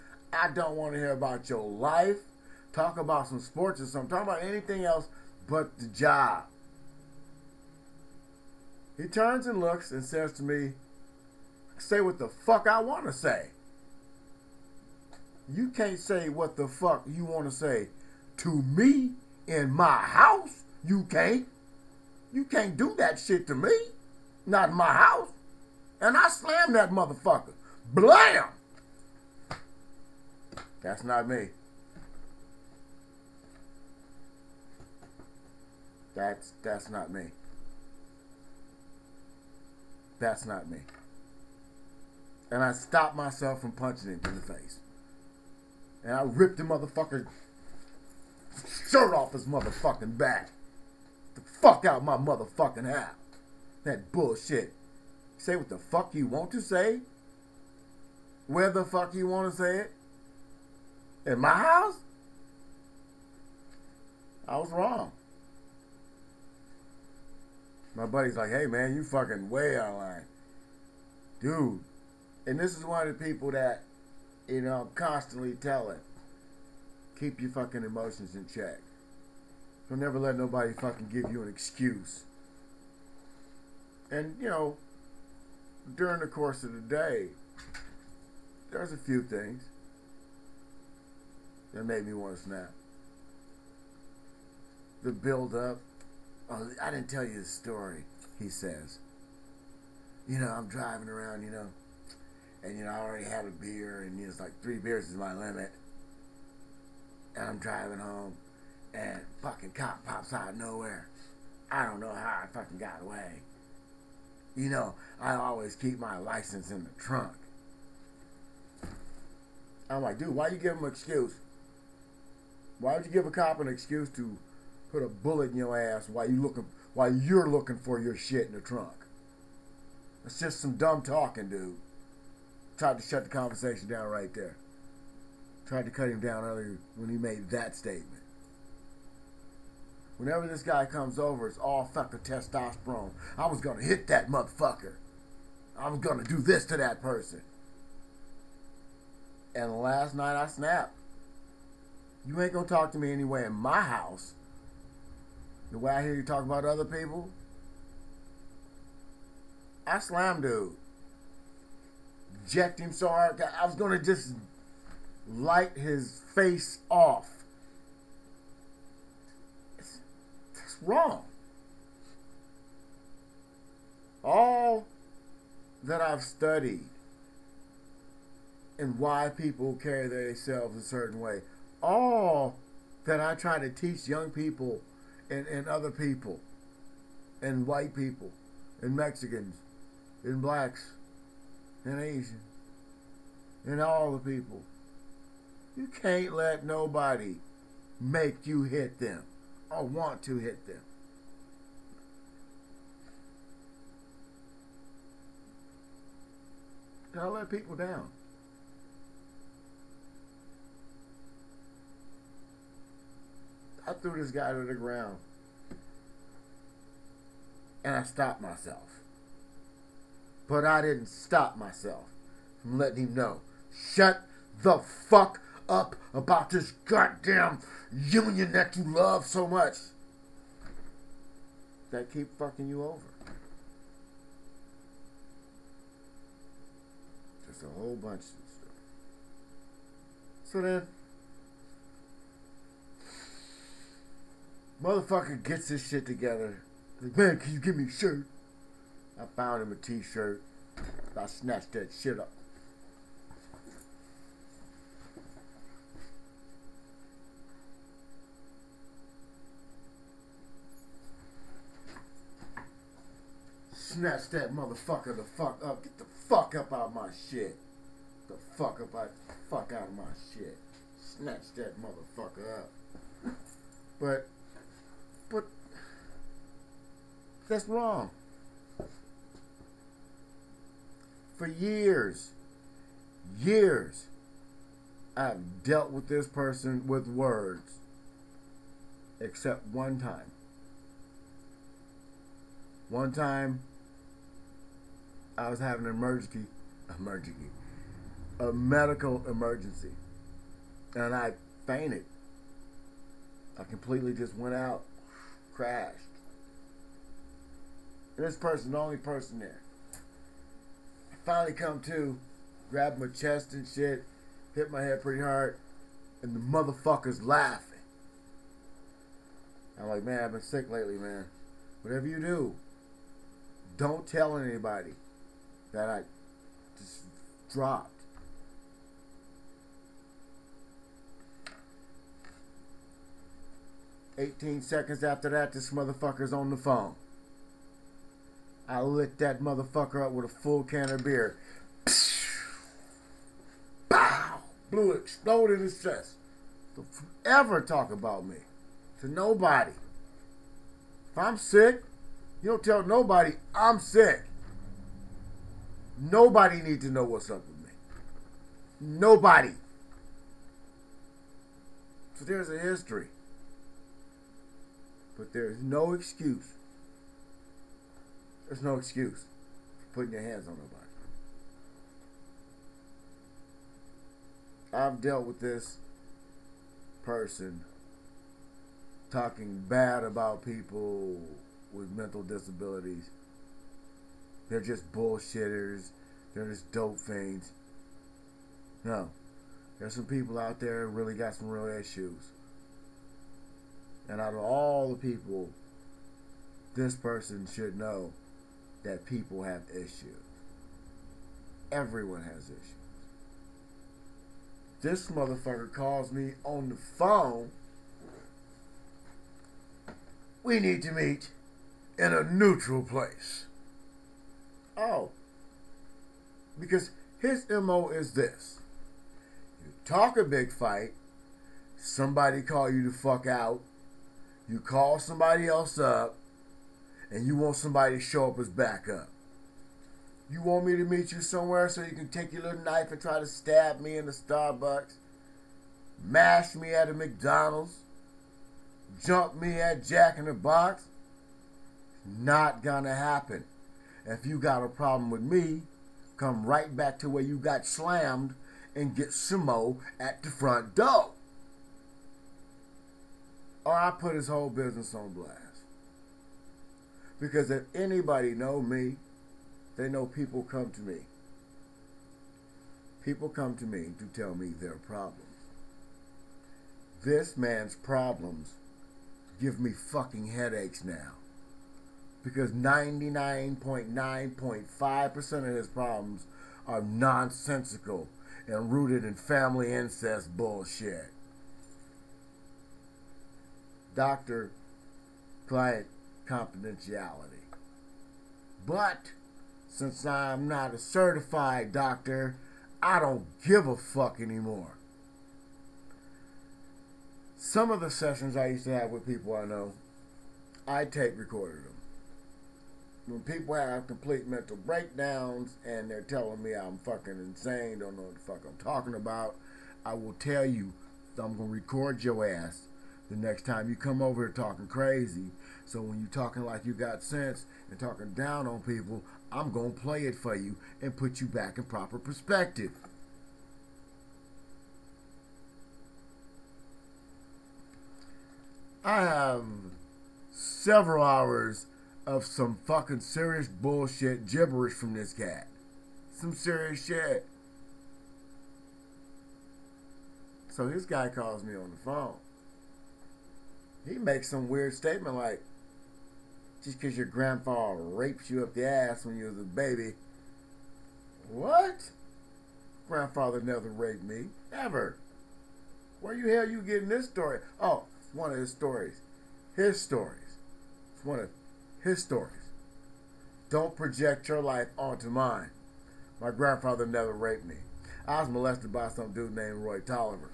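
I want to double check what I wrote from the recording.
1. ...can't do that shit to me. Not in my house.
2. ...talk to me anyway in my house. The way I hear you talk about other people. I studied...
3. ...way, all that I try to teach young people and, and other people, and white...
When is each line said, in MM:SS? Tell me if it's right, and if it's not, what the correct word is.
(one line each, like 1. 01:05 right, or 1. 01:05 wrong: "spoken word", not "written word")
1. 00:22 right
2. 02:32 wrong: "slammed", not "studied"
3. 03:01 right.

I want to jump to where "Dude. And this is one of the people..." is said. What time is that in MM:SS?
01:11.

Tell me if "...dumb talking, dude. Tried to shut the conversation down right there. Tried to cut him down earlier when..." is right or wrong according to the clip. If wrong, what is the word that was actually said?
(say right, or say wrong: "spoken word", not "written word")
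right.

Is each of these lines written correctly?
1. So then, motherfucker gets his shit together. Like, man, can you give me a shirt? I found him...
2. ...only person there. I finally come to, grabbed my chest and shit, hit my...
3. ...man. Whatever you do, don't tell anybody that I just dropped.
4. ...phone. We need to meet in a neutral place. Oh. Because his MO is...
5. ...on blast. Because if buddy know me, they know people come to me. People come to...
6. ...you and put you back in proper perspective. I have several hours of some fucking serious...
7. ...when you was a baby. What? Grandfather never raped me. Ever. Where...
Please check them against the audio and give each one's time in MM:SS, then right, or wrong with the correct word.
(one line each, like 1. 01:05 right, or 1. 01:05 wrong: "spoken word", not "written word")
1. 04:00 right
2. 05:08 right
3. 05:20 right
4. 06:46 right
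5. 07:34 wrong: "anybody", not "buddy"
6. 08:40 right
7. 09:09 right.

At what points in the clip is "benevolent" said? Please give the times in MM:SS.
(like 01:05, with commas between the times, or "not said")
not said.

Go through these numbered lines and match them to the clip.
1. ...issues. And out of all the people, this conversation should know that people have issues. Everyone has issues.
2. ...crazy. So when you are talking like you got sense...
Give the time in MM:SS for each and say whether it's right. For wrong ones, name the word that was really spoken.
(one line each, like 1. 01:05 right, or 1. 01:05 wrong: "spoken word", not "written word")
1. 06:31 wrong: "person", not "conversation"
2. 08:34 right.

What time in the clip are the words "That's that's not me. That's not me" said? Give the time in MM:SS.
00:36.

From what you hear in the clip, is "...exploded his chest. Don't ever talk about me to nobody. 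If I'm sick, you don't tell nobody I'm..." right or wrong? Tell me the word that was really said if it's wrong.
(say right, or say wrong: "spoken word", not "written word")
right.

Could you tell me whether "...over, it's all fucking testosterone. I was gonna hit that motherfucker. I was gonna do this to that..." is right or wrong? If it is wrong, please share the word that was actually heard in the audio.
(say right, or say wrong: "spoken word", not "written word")
right.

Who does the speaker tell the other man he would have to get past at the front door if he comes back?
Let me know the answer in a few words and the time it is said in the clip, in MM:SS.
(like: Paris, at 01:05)
Simo, at 07:29.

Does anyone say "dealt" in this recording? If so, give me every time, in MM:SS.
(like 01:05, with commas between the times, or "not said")
04:45, 06:15.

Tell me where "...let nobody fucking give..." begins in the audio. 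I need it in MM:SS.
01:20.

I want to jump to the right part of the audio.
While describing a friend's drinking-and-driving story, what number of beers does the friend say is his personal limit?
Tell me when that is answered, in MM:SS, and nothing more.
01:44.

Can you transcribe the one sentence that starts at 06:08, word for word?
There's no excuse for putting your hands on nobody.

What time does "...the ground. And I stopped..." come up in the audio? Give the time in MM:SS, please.
03:34.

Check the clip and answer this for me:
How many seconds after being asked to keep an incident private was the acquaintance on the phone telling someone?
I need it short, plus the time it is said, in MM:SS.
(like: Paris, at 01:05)
18, at 05:34.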